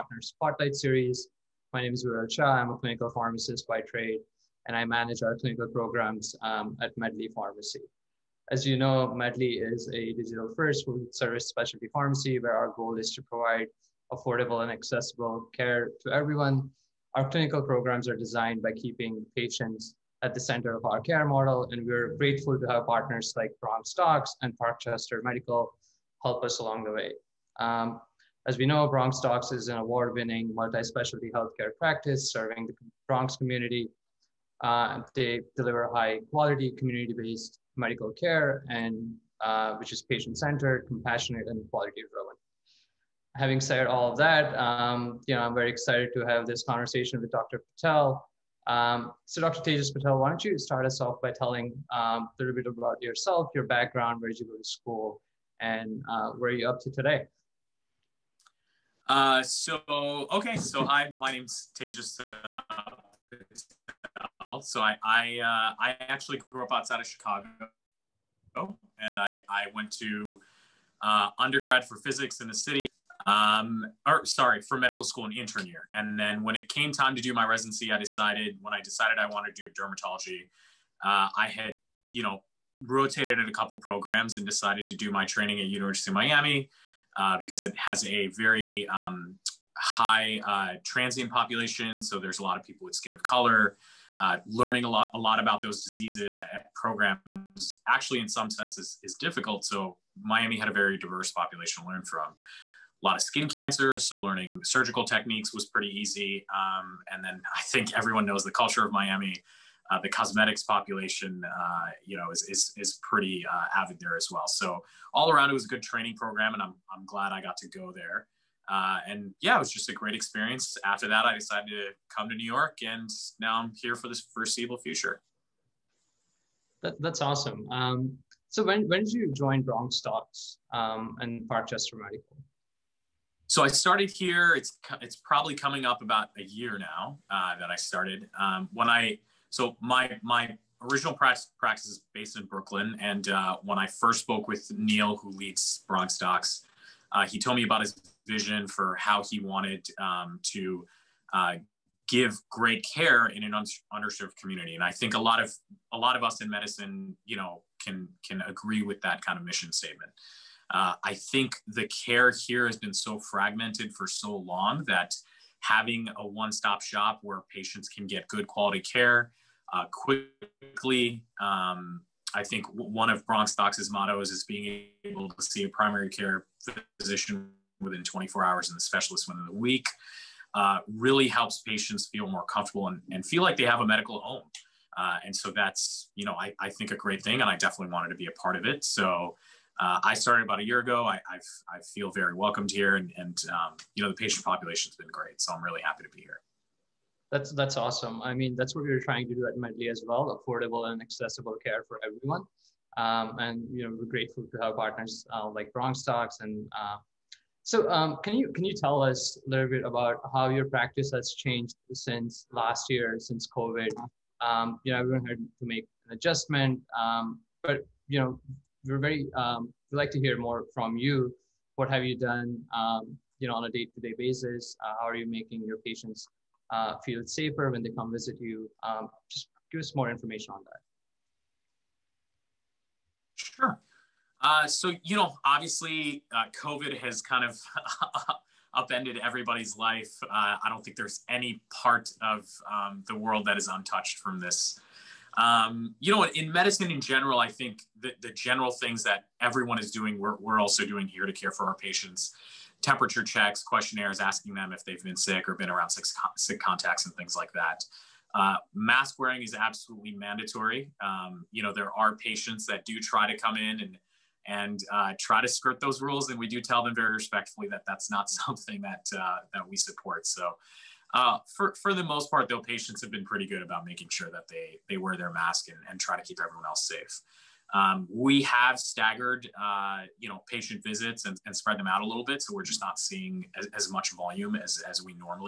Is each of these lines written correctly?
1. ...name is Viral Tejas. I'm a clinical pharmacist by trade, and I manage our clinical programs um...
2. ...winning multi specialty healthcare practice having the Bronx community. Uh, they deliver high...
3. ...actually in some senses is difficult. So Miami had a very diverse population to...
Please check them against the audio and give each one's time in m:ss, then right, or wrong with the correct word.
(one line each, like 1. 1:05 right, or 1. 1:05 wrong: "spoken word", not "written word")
1. 0:01 wrong: "Shah", not "Tejas"
2. 0:30 wrong: "serving", not "having"
3. 1:37 right.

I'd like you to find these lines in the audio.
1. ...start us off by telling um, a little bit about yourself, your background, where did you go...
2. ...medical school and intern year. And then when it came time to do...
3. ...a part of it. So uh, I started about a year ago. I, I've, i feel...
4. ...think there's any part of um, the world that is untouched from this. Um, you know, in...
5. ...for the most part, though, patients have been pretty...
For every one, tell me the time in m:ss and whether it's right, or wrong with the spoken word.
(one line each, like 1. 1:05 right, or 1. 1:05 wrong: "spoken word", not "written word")
1. 0:50 right
2. 1:14 right
3. 3:08 right
4. 4:00 right
5. 4:31 right.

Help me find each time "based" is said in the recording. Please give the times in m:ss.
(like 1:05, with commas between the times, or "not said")
0:37, 2:22.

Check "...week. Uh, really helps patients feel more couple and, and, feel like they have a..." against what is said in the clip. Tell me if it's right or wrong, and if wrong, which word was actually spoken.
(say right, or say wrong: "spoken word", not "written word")
wrong: "comfortable", not "couple".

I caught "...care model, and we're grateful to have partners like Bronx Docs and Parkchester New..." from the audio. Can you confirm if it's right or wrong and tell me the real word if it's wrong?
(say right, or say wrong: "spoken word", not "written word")
wrong: "Medical", not "New".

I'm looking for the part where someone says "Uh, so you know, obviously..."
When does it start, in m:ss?
3:54.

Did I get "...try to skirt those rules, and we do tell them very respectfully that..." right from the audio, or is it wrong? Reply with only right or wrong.
right.